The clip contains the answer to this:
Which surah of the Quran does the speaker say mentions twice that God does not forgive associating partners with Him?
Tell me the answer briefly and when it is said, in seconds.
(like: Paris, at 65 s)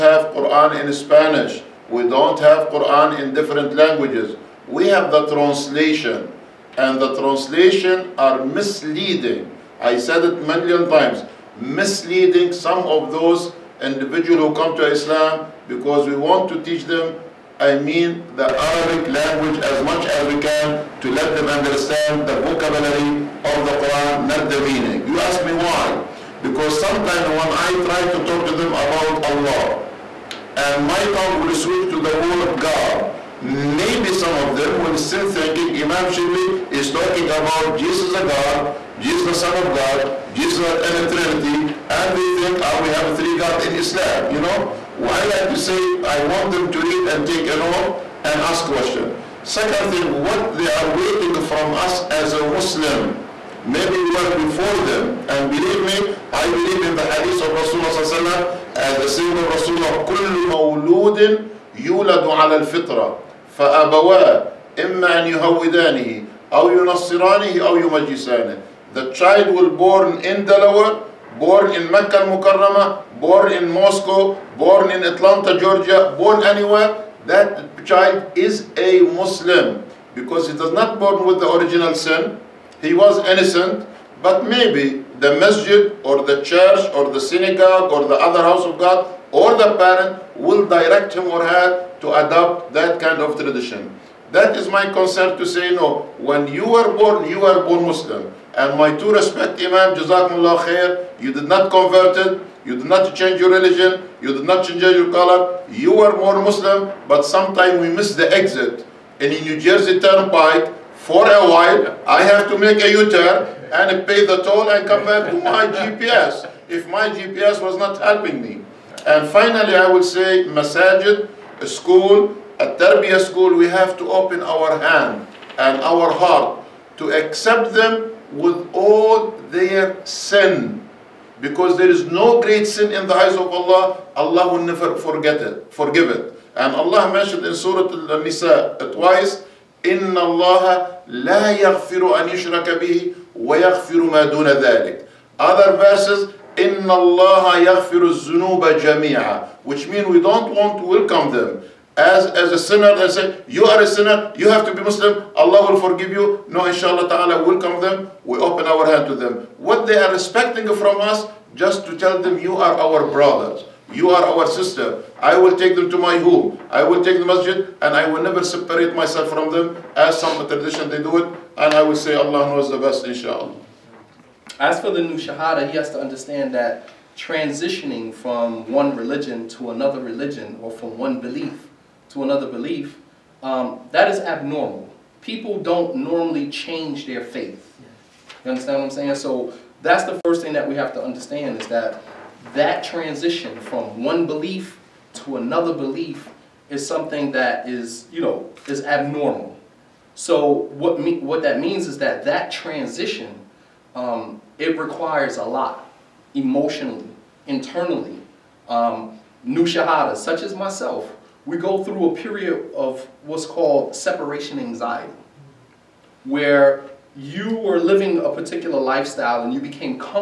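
Surah Al-Nisa, at 137 s.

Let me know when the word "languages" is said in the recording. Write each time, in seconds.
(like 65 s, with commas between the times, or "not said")
3 s, 19 s.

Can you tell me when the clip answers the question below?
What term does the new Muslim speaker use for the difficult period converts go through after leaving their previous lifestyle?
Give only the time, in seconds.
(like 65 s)
213 s.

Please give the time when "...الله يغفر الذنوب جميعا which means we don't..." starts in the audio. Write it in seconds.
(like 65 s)
146 s.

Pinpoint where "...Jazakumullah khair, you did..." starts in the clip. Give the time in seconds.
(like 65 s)
99 s.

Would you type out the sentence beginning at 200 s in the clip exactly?
So what, me, what that means is that that transition, um, it requires a lot emotionally, internally.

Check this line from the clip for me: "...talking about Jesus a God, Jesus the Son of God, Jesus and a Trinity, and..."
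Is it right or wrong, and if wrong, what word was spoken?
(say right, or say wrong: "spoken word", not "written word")
right.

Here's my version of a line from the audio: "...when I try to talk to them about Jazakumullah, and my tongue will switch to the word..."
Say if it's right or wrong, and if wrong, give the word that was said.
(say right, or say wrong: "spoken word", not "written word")
wrong: "Allah", not "Jazakumullah".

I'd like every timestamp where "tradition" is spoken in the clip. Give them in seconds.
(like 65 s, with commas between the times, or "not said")
93 s, 170 s.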